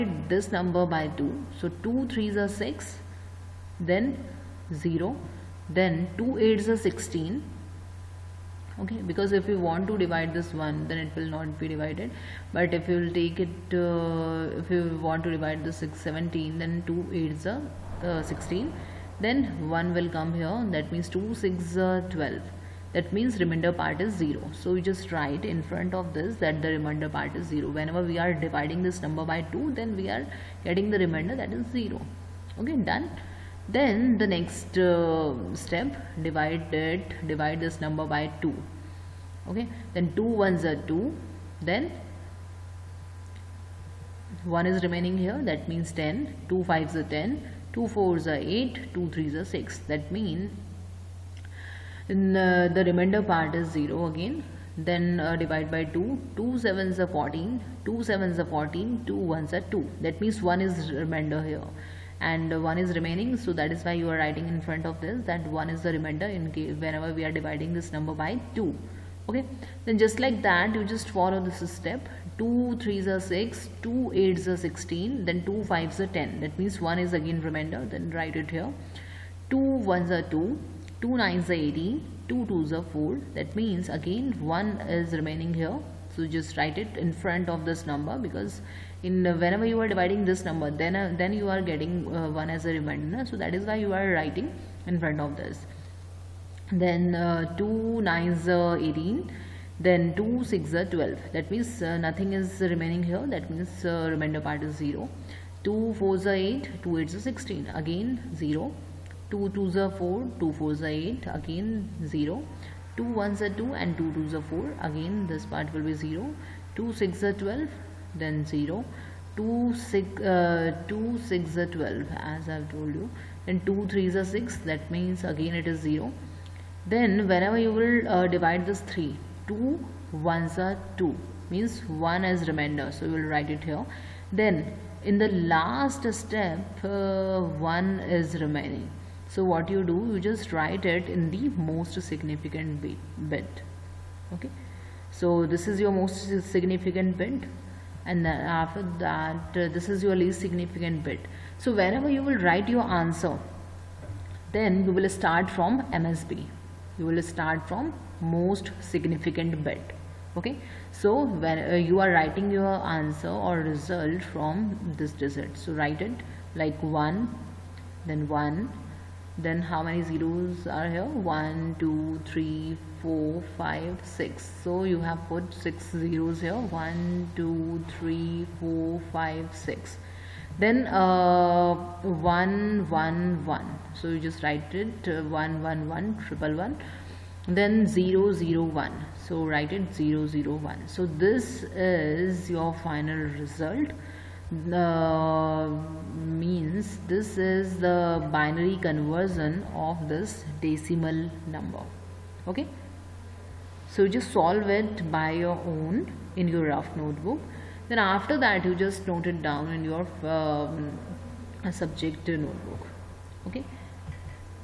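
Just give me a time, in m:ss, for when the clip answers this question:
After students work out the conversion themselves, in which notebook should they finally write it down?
3:31.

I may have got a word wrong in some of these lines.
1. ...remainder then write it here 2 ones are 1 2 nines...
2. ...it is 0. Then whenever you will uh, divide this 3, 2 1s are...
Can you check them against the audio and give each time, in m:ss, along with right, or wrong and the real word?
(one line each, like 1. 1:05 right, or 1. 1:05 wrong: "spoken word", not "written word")
1. 1:17 wrong: "2", not "1"
2. 2:05 right.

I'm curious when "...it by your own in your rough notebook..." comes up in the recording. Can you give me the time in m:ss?
3:24.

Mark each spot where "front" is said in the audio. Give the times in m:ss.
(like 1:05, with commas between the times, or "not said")
0:25, 1:04, 1:27, 1:35.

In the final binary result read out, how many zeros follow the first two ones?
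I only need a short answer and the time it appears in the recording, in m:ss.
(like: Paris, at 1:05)
6, at 2:55.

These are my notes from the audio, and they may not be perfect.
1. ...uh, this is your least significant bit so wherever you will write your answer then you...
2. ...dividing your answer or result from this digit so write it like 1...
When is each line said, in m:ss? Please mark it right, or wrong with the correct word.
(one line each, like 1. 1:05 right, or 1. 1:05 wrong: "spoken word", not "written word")
1. 2:29 right
2. 2:42 wrong: "writing", not "dividing".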